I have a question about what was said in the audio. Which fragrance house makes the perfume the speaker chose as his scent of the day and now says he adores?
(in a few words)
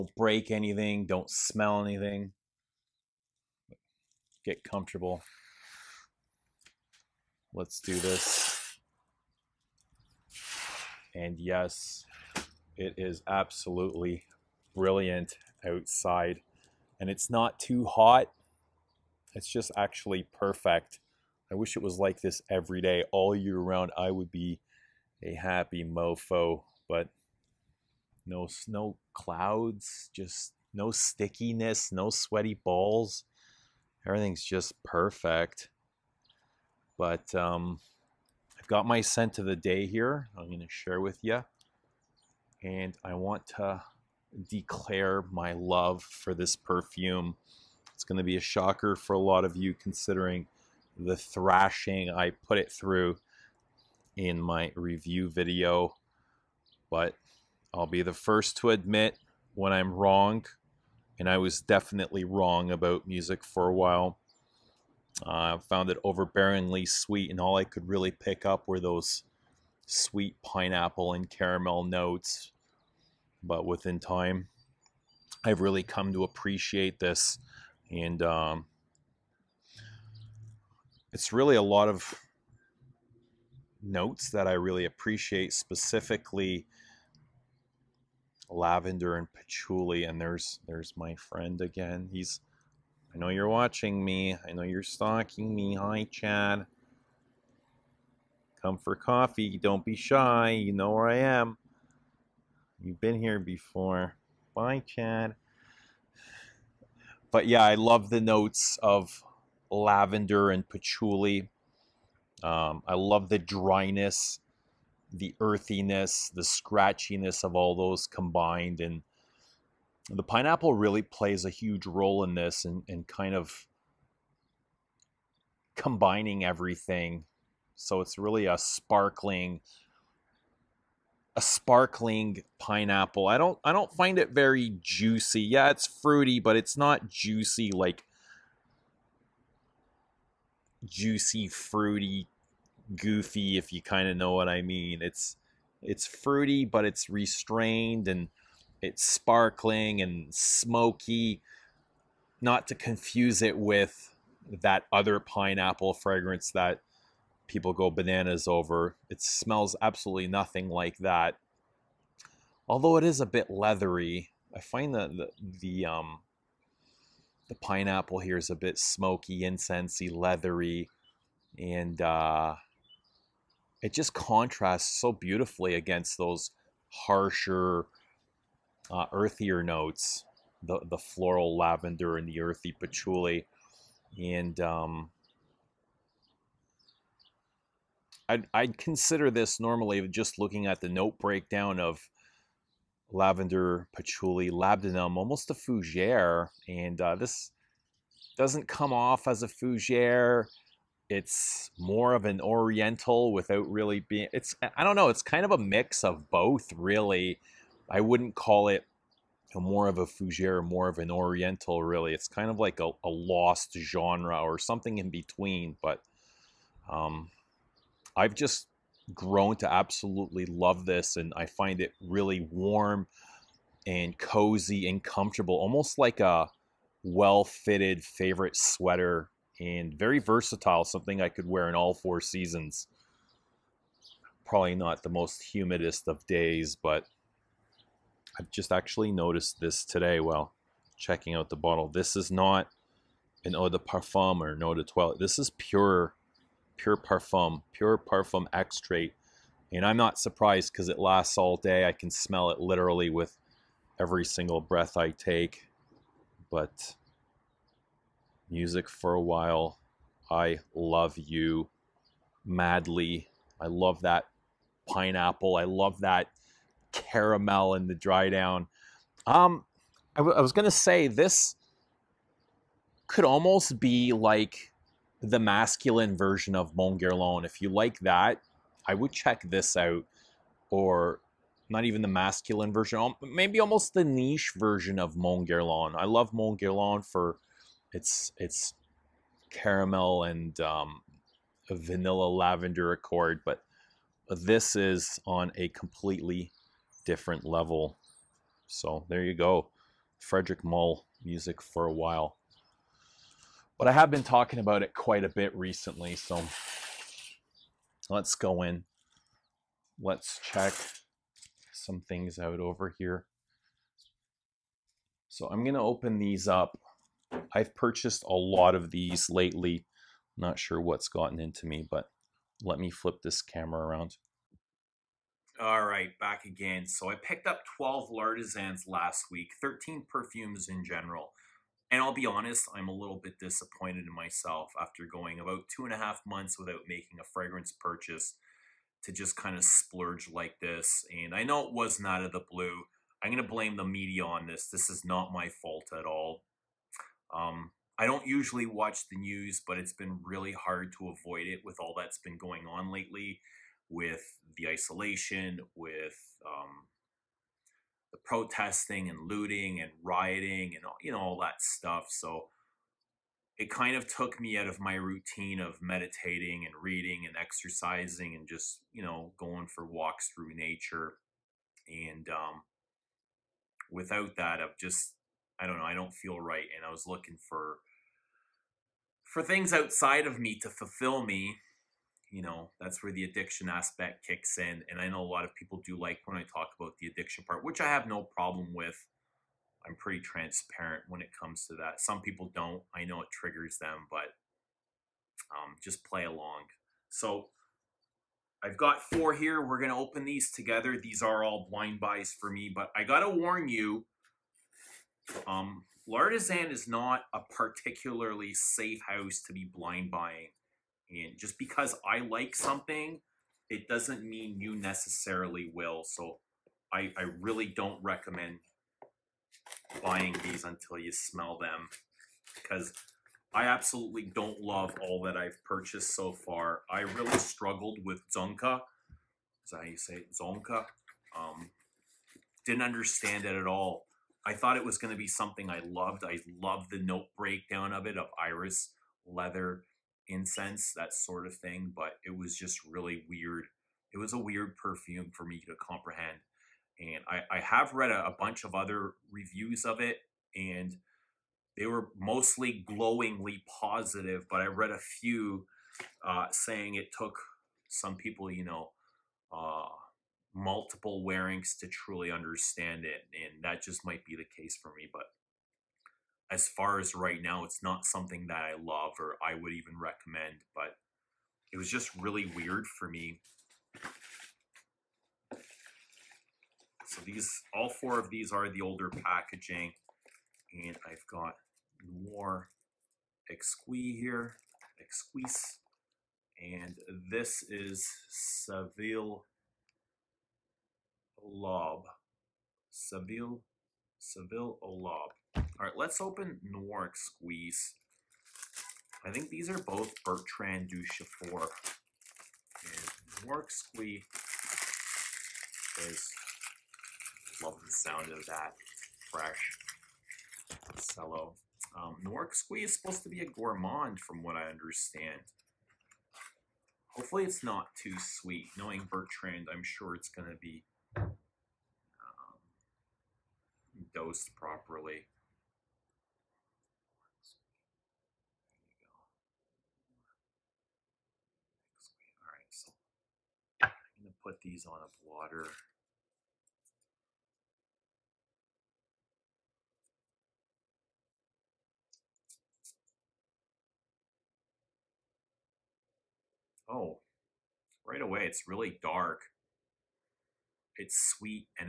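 Frederic Malle.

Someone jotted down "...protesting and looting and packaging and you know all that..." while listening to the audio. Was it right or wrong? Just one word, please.
wrong.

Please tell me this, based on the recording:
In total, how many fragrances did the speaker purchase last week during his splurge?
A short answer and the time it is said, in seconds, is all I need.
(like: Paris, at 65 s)
13, at 329 s.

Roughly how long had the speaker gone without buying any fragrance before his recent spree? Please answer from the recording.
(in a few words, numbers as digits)
two and a half months.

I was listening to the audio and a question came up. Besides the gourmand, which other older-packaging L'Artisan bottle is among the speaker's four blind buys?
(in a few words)
Seville à l'Aube.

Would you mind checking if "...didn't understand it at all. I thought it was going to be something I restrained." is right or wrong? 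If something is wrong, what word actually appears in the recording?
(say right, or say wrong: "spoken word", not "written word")
wrong: "loved", not "restrained".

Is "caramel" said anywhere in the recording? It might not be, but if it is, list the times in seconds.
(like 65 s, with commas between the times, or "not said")
71 s, 266 s, 289 s.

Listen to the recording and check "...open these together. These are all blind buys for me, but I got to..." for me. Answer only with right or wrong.
right.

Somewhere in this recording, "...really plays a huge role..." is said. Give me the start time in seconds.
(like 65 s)
120 s.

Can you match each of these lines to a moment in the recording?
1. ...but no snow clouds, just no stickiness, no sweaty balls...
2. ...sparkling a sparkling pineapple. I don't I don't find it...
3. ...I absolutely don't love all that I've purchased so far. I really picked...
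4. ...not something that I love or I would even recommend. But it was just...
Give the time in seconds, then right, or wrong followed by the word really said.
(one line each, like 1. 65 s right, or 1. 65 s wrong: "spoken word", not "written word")
1. 26 s right
2. 128 s right
3. 423 s wrong: "struggled", not "picked"
4. 467 s right.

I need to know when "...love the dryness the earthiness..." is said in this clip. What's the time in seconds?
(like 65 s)
112 s.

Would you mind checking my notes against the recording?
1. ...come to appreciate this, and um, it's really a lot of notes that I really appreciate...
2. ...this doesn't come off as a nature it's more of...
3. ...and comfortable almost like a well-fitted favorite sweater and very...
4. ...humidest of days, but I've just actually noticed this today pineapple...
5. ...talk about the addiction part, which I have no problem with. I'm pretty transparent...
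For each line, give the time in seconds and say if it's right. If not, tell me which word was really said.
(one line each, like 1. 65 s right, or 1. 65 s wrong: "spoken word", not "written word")
1. 75 s right
2. 197 s wrong: "fougere", not "nature"
3. 224 s right
4. 235 s wrong: "while", not "pineapple"
5. 386 s right.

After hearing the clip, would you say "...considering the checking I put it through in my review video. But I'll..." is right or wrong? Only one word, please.
wrong.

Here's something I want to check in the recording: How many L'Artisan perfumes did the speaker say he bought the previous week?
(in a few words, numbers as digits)
12.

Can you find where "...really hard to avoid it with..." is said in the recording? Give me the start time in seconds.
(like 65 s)
350 s.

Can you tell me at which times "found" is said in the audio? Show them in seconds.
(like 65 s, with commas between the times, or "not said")
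65 s.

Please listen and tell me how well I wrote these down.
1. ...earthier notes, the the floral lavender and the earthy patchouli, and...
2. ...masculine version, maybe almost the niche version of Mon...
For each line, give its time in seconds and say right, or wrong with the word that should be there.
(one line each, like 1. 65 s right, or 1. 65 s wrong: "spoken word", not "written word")
1. 179 s right
2. 282 s right.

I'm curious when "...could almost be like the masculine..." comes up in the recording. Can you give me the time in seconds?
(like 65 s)
273 s.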